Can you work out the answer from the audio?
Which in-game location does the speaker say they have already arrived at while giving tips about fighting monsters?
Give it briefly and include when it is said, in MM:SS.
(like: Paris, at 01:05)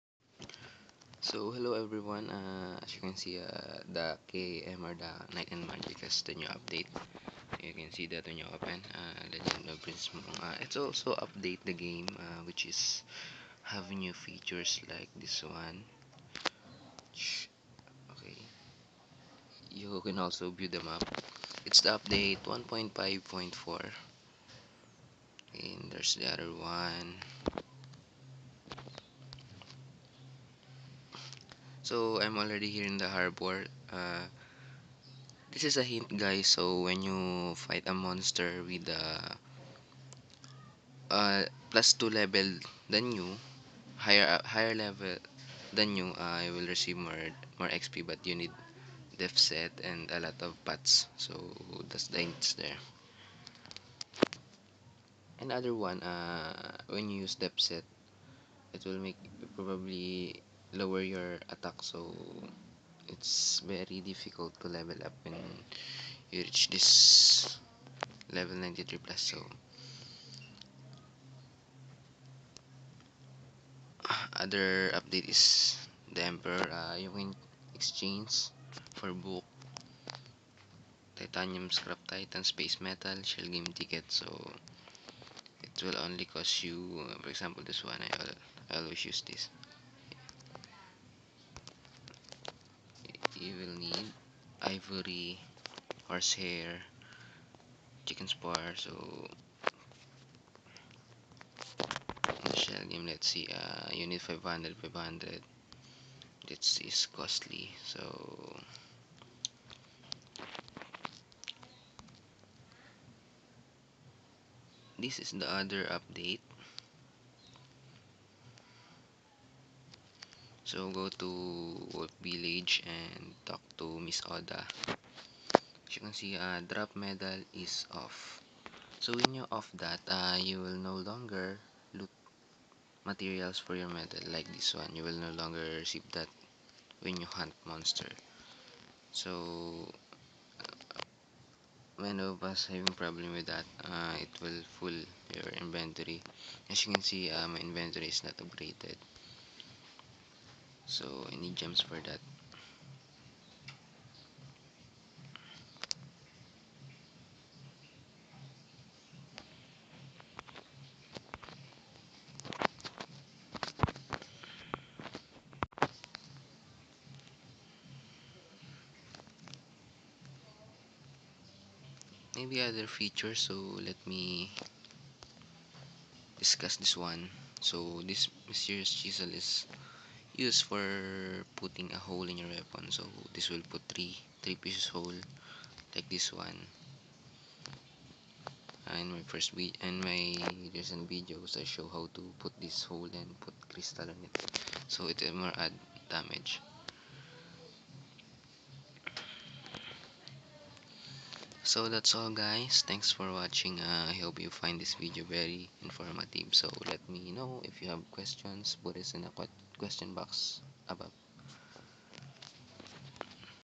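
The harbor, at 00:33.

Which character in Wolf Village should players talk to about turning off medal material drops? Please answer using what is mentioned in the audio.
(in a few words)
Miss Oda.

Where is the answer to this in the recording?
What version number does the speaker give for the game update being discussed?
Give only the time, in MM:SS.
00:22.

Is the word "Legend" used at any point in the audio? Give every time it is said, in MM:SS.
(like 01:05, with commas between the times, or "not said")
00:09.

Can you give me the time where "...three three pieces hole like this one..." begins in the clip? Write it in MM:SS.
03:03.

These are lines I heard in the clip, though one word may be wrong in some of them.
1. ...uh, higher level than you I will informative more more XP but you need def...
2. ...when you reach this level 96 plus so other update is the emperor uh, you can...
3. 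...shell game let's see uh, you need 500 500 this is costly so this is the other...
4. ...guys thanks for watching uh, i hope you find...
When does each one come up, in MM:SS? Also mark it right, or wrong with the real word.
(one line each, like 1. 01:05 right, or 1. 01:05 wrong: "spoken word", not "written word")
1. 00:44 wrong: "receive", not "informative"
2. 01:05 wrong: "93", not "96"
3. 01:42 right
4. 03:22 right.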